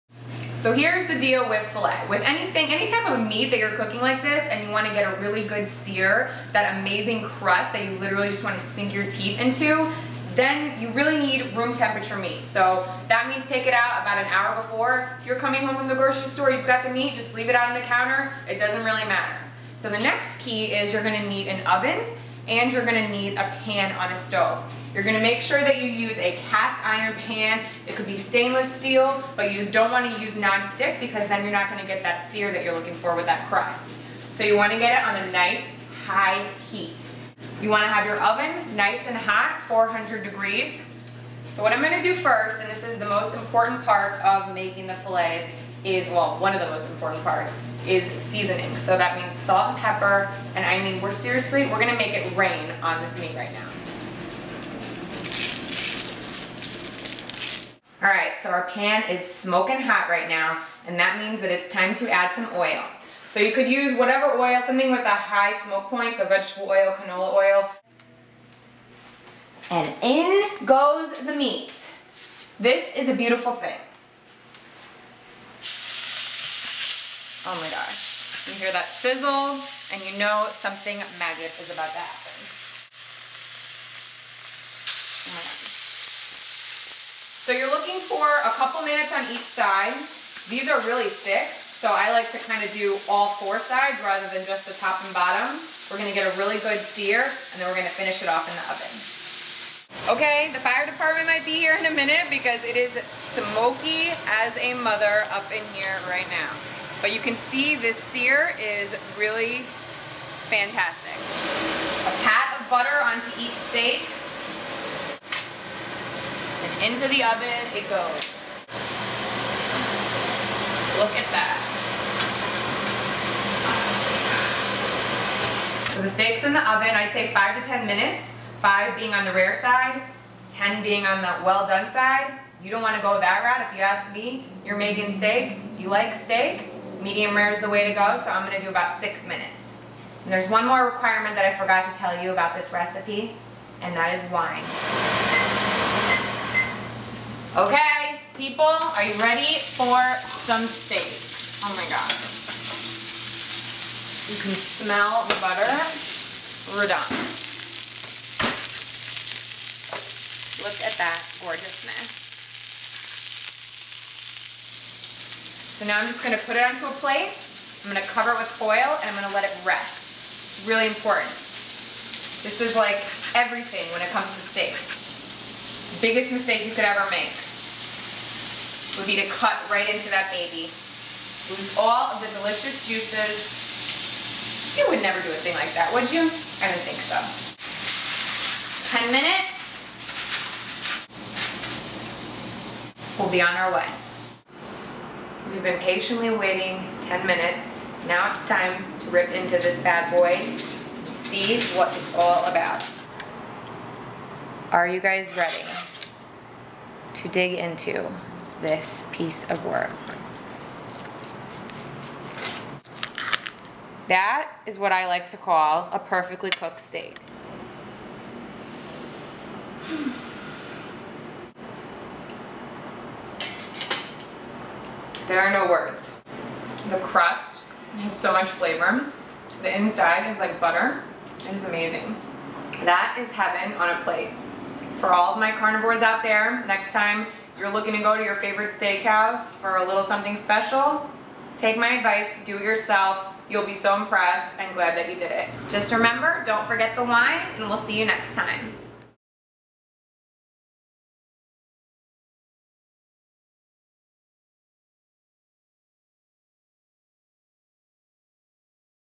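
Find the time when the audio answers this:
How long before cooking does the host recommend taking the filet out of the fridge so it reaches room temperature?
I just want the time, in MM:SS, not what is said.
00:14.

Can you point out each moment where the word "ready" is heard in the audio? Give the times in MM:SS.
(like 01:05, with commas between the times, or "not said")
02:29, 03:25.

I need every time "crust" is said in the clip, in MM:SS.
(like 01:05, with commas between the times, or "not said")
00:07, 00:33, 03:46.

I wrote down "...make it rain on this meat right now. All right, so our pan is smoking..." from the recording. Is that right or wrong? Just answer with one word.
right.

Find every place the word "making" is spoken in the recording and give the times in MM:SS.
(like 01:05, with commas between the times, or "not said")
00:44, 02:14.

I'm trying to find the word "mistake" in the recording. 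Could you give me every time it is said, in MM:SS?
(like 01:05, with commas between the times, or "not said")
02:56.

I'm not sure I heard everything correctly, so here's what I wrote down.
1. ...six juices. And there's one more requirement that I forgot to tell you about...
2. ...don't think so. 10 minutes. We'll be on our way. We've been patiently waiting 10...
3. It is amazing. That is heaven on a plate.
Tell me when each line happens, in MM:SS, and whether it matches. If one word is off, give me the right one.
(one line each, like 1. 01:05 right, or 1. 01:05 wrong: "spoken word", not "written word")
1. 02:18 wrong: "minutes", not "juices"
2. 03:06 right
3. 03:51 right.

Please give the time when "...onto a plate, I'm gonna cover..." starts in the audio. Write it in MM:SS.
02:46.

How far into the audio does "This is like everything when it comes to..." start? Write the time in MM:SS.
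02:52.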